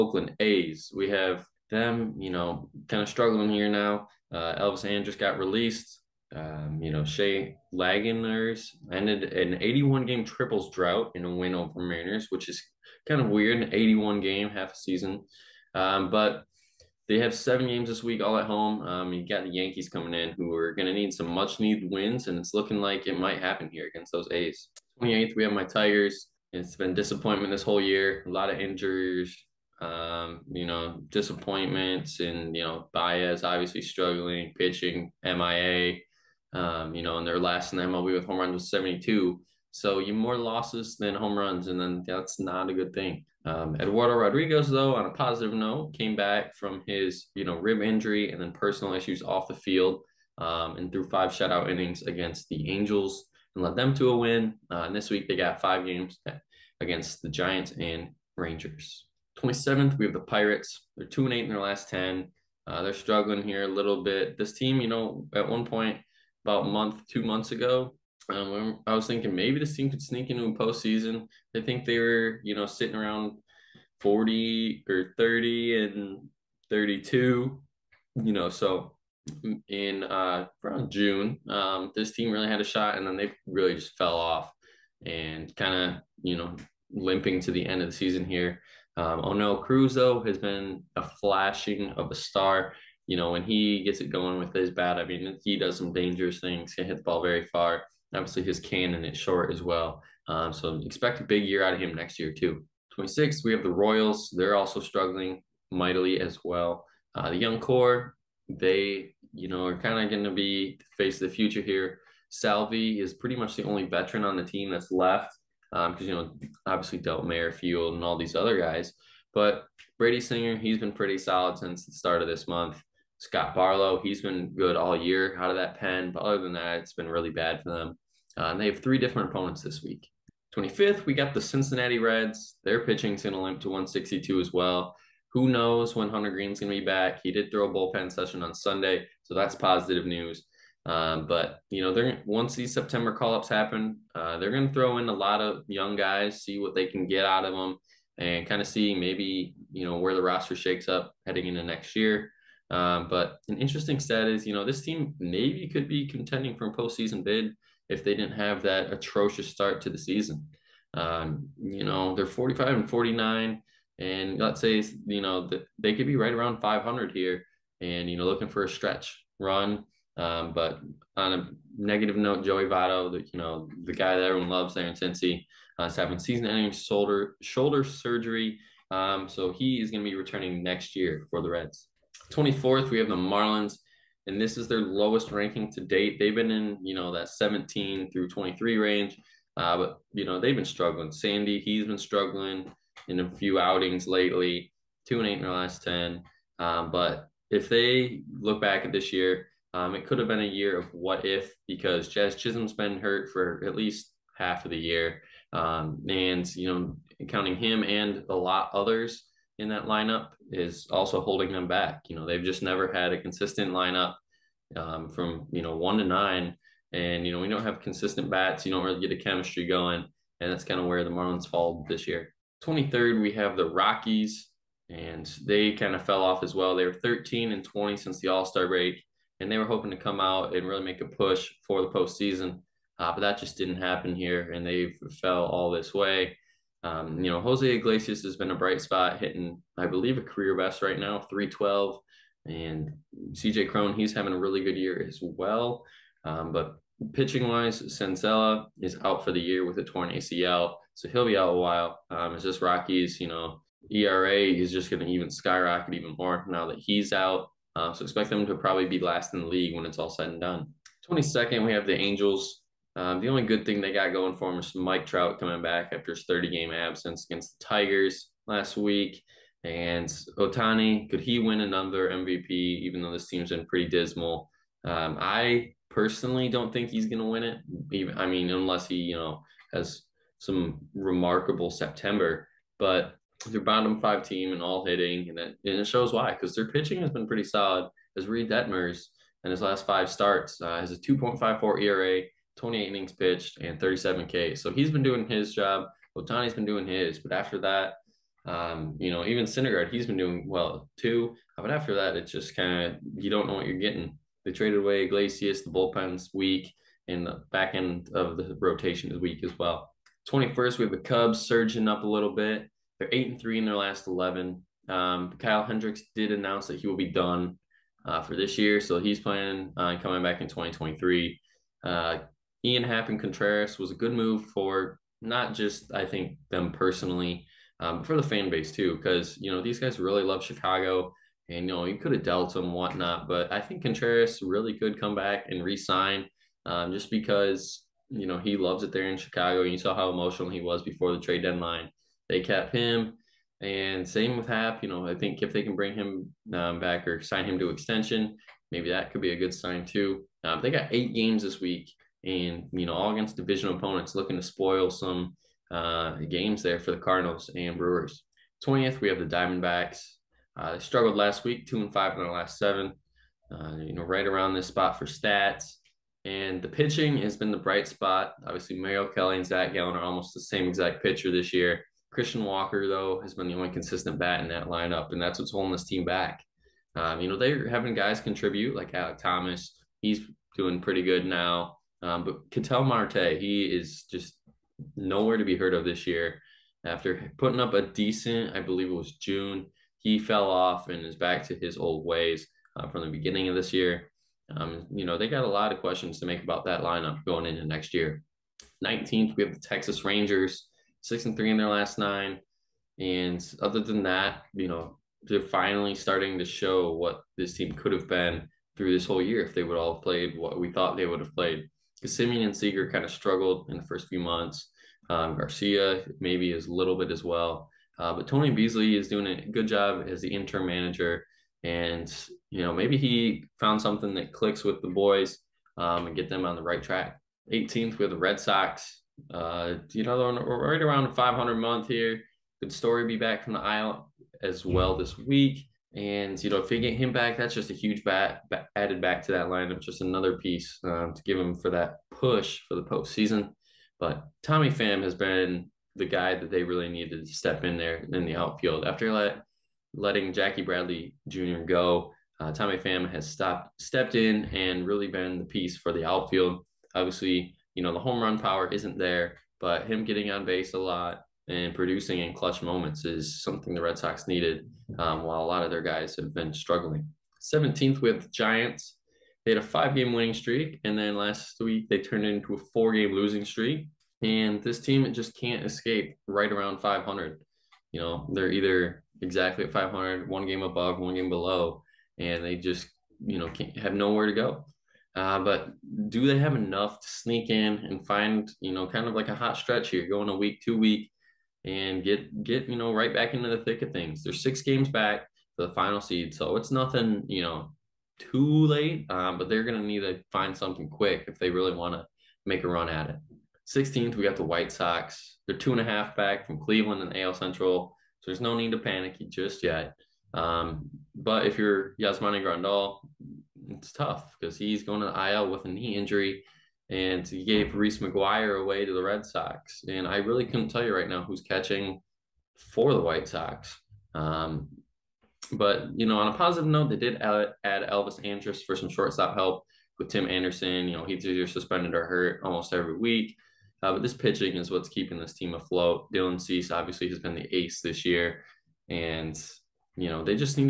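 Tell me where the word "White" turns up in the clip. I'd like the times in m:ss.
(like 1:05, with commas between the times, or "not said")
8:24, 8:43.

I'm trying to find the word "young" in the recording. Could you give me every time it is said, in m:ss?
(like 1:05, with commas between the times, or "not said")
1:47, 2:25.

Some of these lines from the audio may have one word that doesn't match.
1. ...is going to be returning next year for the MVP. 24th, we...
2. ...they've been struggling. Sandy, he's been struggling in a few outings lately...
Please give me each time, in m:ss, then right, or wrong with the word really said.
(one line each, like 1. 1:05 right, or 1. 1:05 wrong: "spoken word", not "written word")
1. 2:59 wrong: "Reds", not "MVP"
2. 3:10 right.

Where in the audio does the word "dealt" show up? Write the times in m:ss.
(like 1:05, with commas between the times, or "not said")
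1:56, 5:32.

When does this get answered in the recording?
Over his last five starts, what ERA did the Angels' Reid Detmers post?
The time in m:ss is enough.
4:50.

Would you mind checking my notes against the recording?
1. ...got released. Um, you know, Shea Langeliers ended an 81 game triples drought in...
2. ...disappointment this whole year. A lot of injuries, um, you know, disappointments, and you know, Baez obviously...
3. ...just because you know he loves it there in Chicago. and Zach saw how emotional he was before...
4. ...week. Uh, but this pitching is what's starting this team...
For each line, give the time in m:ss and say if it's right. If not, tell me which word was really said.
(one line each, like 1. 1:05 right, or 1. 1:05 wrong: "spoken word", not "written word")
1. 0:05 right
2. 0:26 right
3. 5:36 wrong: "You", not "Zach"
4. 8:52 wrong: "keeping", not "starting".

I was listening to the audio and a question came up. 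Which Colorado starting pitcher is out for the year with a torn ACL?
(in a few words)
Senzatela.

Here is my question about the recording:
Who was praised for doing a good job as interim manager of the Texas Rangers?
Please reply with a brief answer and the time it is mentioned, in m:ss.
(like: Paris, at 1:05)
Tony Beasley, at 6:58.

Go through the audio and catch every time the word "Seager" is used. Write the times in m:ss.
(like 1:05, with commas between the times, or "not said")
6:52.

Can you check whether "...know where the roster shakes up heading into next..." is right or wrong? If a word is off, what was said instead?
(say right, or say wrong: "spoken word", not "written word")
right.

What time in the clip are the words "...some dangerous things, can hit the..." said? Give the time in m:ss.
1:35.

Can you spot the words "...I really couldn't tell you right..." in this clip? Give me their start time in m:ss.
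8:40.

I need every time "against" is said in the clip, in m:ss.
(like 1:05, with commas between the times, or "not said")
0:23, 0:52, 0:56, 4:27, 5:53.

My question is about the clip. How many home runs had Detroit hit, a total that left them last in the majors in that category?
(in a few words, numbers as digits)
72.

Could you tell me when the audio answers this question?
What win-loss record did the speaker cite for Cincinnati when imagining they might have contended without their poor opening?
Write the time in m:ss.
2:42.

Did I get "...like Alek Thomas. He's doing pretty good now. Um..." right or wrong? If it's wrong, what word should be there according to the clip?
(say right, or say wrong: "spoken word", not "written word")
right.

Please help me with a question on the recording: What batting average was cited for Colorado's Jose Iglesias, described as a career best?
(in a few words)
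.312.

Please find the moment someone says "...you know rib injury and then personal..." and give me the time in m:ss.
0:47.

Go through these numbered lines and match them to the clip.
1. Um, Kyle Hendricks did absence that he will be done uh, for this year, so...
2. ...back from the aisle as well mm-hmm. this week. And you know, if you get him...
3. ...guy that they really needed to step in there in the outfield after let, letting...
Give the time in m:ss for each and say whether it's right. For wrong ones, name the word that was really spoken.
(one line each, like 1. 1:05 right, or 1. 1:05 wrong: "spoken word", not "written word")
1. 5:14 wrong: "announce", not "absence"
2. 7:13 right
3. 7:26 right.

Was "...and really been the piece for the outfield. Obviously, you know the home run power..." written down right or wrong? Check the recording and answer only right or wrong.
right.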